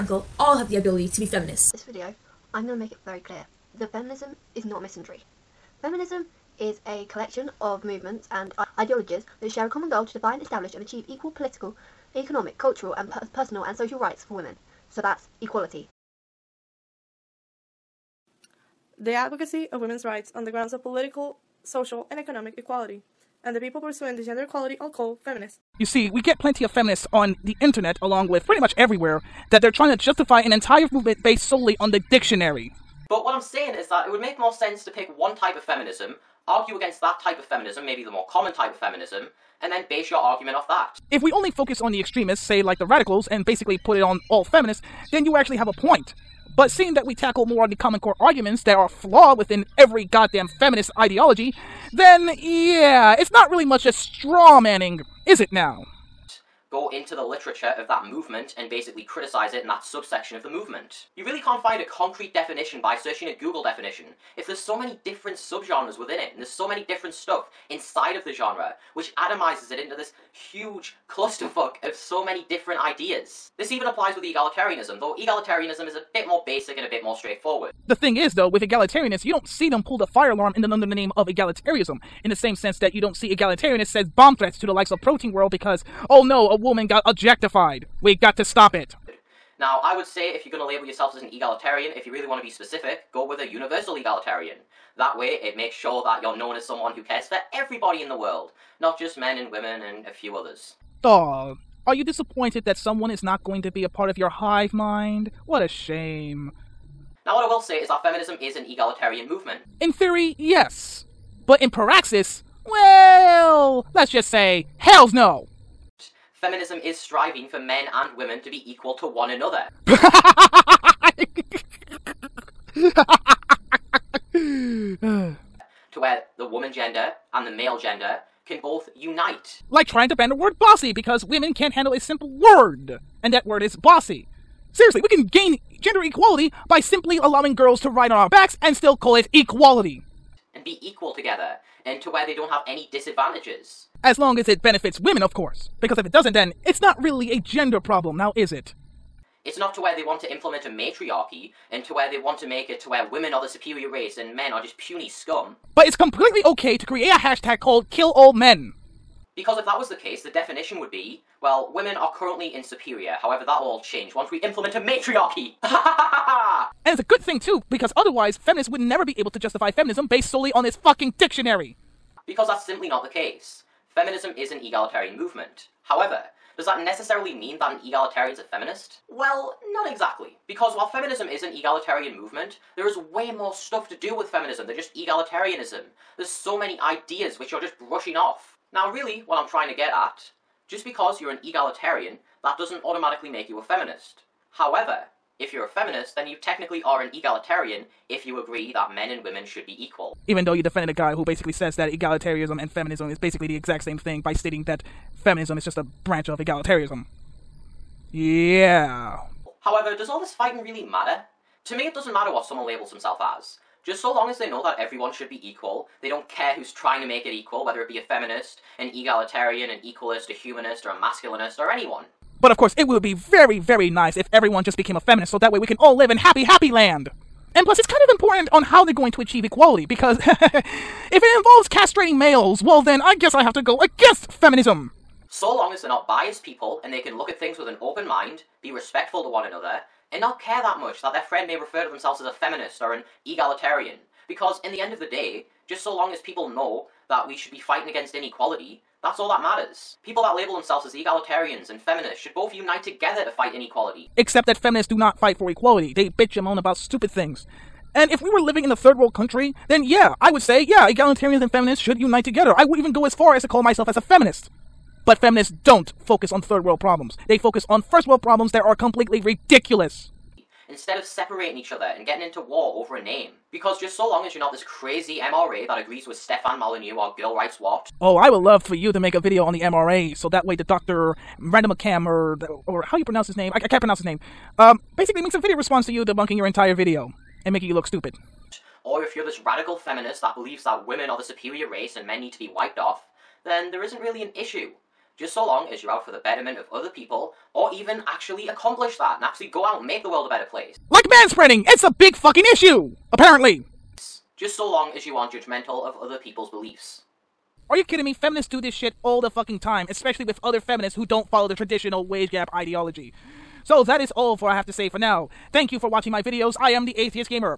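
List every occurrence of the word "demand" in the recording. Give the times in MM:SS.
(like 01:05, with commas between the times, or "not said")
not said.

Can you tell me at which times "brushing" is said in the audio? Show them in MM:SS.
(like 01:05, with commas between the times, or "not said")
03:07.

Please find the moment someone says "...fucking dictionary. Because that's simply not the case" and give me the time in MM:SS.
02:50.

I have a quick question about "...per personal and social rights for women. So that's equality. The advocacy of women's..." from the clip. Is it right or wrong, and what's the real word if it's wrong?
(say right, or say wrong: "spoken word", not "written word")
right.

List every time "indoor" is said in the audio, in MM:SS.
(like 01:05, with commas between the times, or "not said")
not said.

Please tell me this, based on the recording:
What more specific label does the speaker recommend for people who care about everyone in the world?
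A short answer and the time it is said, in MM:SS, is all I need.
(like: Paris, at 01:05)
universal egalitarian, at 01:33.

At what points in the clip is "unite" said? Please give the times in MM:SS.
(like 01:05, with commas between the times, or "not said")
04:12, 04:21.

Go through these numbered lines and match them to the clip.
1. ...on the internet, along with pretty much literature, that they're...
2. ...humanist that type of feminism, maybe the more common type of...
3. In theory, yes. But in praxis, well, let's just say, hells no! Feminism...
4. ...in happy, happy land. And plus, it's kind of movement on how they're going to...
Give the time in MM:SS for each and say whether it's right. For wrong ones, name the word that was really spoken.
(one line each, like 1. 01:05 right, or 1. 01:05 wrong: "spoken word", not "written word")
1. 00:27 wrong: "everywhere", not "literature"
2. 00:36 wrong: "against", not "humanist"
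3. 01:49 right
4. 03:46 wrong: "important", not "movement".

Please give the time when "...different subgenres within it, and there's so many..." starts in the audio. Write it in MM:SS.
01:05.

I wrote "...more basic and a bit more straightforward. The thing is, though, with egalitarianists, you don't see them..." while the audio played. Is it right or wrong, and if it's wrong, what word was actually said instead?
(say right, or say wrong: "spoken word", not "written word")
right.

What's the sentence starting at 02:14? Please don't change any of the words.
Seriously, we can gain gender equality by simply allowing girls to ride on our backs and still call it equality.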